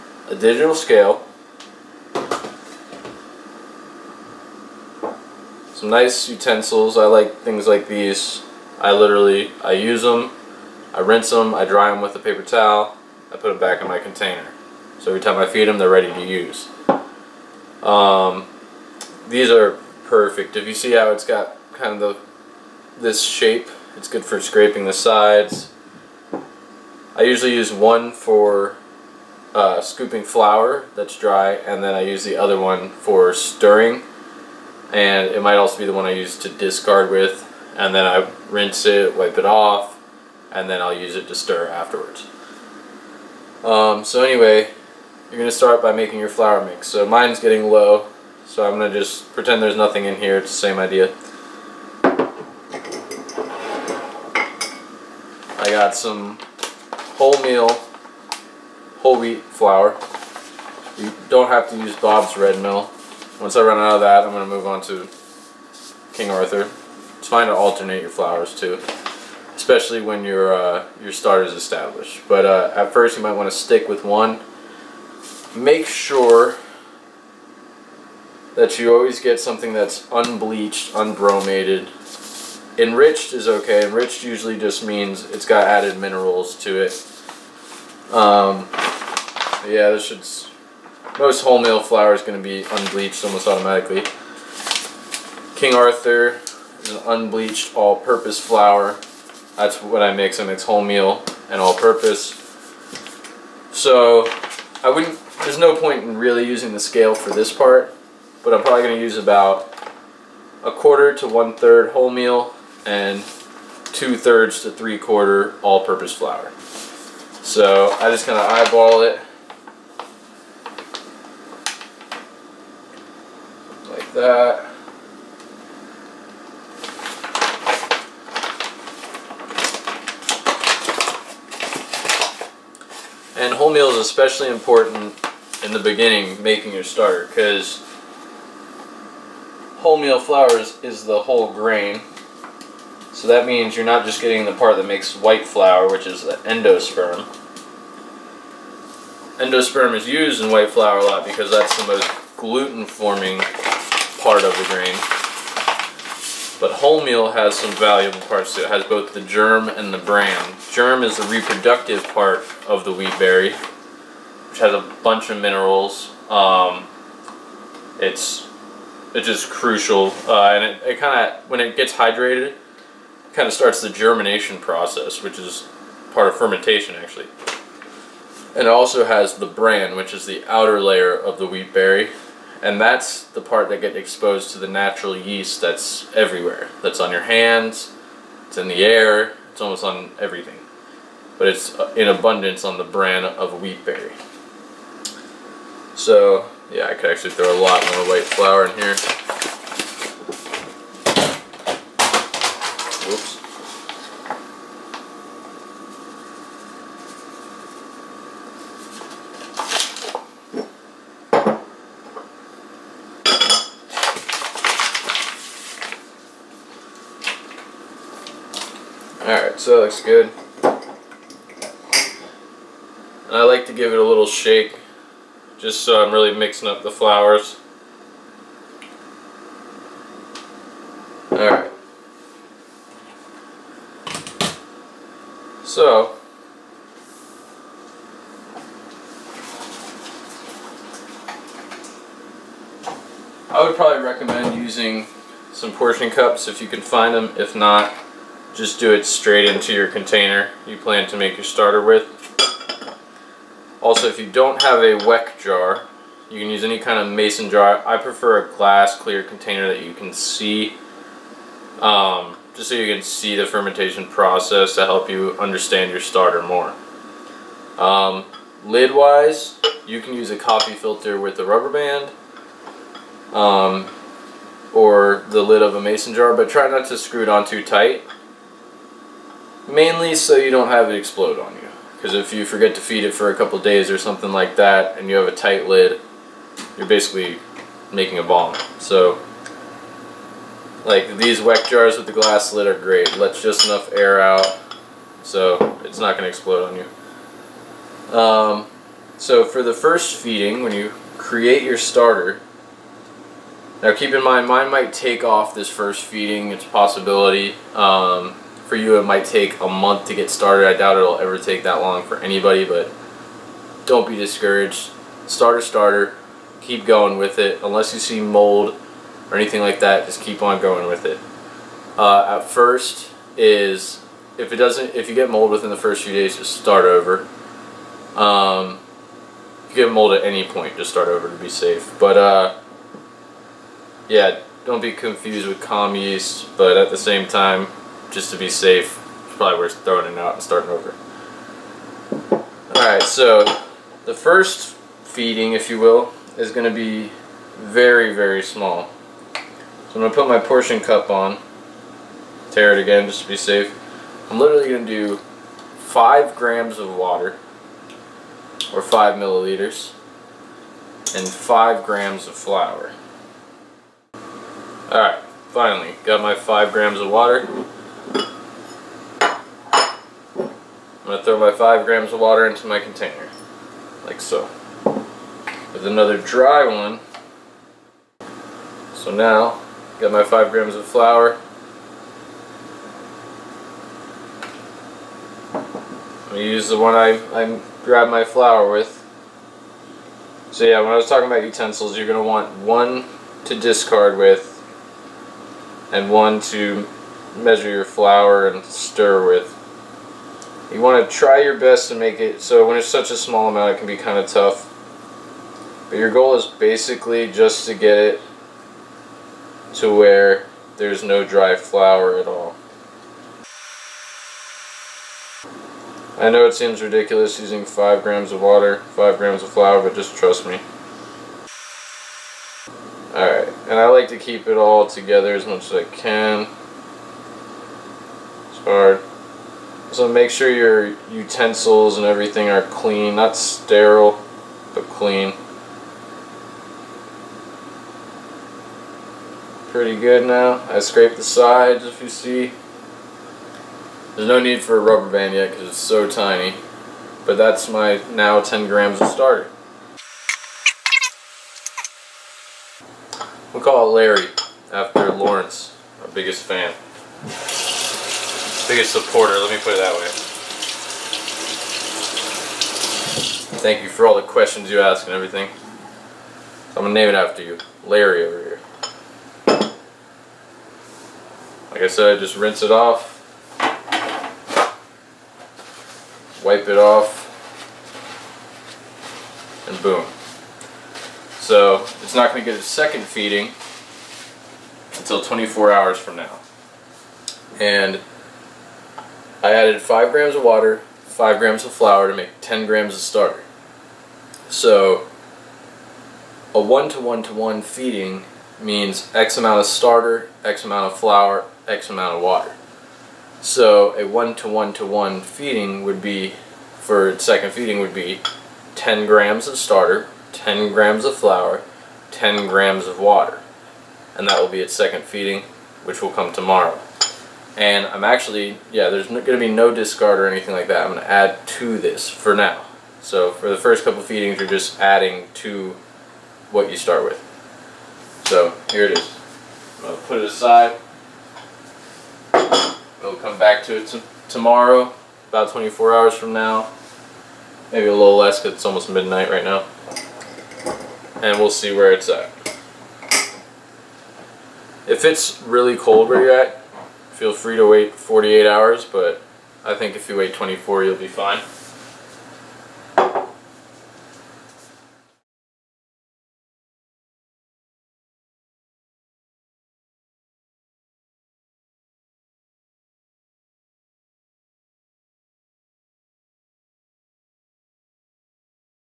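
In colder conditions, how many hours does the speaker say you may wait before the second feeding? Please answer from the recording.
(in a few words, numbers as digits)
48 hours.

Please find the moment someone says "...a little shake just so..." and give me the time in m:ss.
3:43.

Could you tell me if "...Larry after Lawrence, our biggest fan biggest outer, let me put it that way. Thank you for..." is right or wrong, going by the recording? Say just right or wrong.
wrong.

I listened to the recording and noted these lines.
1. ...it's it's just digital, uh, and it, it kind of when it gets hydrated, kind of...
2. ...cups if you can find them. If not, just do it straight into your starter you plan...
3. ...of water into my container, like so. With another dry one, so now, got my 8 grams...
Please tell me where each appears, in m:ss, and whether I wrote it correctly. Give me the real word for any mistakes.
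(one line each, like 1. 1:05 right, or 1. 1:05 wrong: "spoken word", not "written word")
1. 2:47 wrong: "crucial", not "digital"
2. 4:06 wrong: "container", not "starter"
3. 6:12 wrong: "5", not "8".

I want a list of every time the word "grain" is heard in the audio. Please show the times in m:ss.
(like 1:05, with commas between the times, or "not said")
2:21, 2:34.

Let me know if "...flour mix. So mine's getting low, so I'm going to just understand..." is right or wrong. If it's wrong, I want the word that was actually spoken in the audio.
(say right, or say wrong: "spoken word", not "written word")
wrong: "pretend", not "understand".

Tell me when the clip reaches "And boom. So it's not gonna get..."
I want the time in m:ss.
7:59.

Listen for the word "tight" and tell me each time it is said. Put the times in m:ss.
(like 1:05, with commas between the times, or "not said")
4:37, 4:45.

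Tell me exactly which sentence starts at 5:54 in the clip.
I'm literally going to do 5 grams of water, or 5 milliliters, and 5 grams of flour.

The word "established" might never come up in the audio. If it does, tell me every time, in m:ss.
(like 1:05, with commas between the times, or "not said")
1:11.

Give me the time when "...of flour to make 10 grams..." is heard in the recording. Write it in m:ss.
8:11.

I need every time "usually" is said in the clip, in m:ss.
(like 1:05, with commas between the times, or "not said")
0:27, 1:24.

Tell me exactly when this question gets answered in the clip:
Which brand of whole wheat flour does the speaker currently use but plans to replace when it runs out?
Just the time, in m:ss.
1:01.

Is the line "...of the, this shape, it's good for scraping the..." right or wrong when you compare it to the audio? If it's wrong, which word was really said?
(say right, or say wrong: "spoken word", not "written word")
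right.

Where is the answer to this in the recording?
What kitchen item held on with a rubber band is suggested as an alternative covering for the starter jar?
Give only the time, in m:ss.
4:30.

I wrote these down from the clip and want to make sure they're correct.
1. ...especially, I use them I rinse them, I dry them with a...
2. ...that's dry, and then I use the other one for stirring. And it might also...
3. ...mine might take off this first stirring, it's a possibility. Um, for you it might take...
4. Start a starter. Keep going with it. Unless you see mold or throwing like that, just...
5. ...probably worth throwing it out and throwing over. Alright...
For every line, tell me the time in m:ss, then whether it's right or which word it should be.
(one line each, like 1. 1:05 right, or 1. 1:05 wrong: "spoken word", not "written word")
1. 0:08 wrong: "literally", not "especially"
2. 0:30 right
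3. 5:04 wrong: "feeding", not "stirring"
4. 5:15 wrong: "anything", not "throwing"
5. 5:39 wrong: "starting", not "throwing".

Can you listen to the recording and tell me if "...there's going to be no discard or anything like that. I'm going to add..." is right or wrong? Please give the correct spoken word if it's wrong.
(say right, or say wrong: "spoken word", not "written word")
right.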